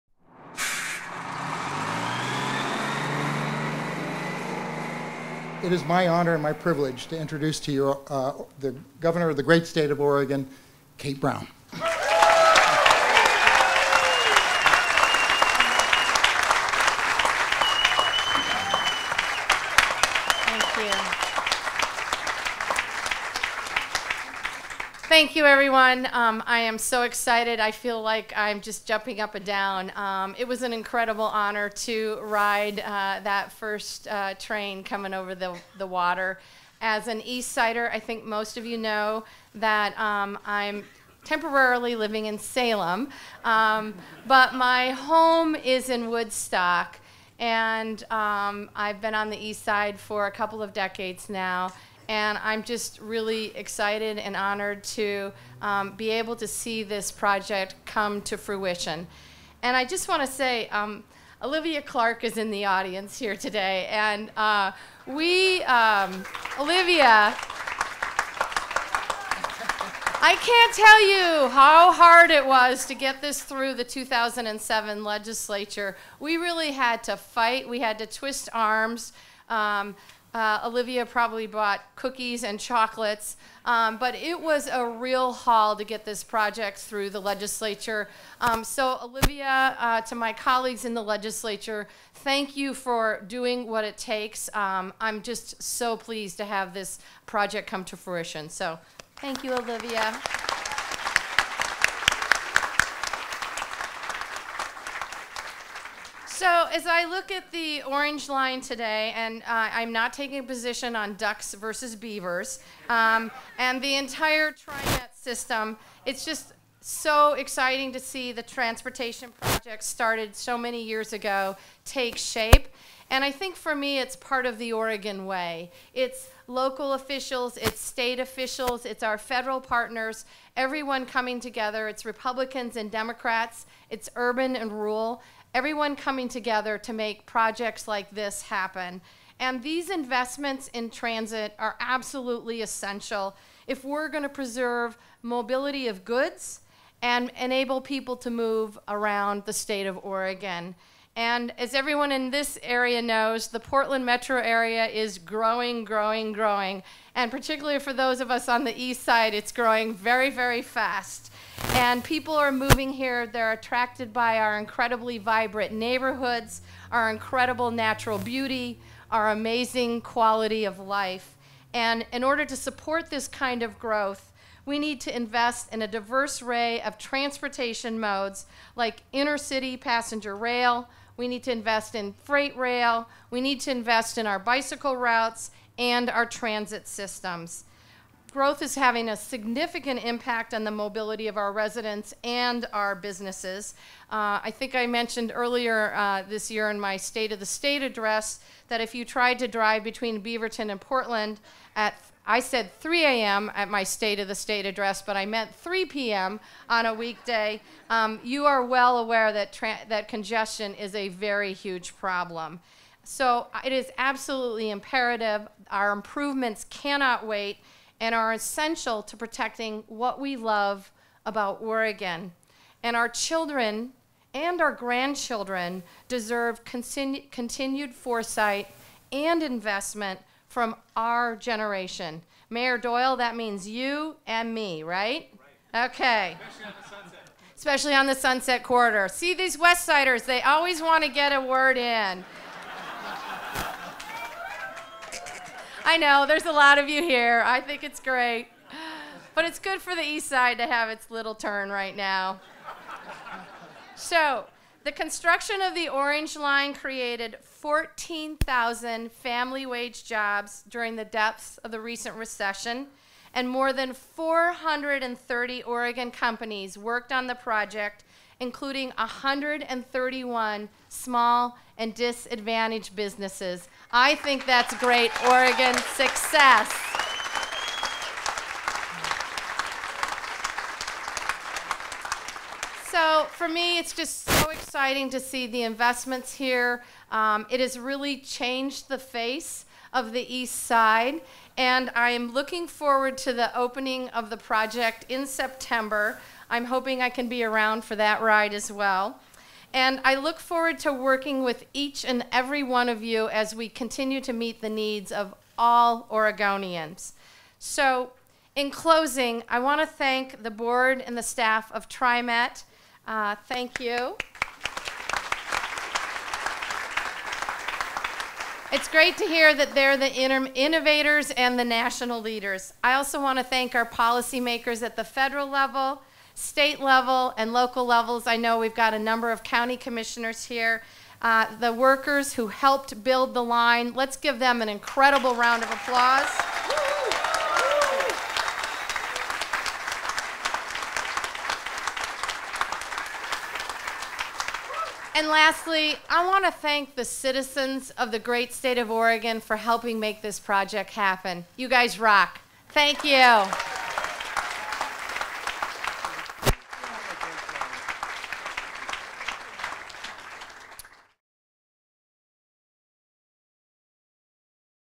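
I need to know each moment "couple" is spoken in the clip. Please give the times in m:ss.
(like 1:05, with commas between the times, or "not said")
0:50.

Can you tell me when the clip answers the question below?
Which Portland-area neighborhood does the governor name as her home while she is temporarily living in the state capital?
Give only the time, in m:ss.
0:46.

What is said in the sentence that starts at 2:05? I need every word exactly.
It's local officials, it's state officials, it's our federal partners, everyone coming together.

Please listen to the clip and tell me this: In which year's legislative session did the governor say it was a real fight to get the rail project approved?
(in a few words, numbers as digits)
2007.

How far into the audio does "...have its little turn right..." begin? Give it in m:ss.
4:10.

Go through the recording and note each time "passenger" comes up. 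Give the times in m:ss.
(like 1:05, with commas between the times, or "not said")
2:59.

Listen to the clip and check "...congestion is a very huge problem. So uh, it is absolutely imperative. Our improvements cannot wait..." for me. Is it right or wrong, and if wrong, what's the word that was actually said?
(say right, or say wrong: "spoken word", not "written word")
right.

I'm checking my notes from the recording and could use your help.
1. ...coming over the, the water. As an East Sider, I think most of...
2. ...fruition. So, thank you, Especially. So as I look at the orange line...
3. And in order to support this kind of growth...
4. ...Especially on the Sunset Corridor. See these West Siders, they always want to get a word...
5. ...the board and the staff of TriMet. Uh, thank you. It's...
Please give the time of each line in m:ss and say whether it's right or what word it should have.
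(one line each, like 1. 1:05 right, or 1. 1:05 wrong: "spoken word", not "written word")
1. 0:34 right
2. 1:37 wrong: "Olivia", not "Especially"
3. 2:51 right
4. 3:57 right
5. 5:10 right.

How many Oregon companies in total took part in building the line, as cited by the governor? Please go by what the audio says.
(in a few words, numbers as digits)
430.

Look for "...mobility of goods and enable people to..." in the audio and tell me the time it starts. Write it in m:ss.
2:25.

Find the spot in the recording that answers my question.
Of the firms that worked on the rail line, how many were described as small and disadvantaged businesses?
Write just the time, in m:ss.
4:28.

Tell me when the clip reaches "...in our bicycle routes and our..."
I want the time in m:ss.
3:04.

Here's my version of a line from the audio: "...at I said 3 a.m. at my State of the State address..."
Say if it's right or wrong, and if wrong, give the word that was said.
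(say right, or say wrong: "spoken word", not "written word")
right.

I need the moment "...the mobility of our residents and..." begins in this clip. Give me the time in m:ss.
3:10.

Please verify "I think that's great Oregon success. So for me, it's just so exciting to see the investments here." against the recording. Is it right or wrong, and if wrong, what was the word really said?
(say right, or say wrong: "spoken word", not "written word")
right.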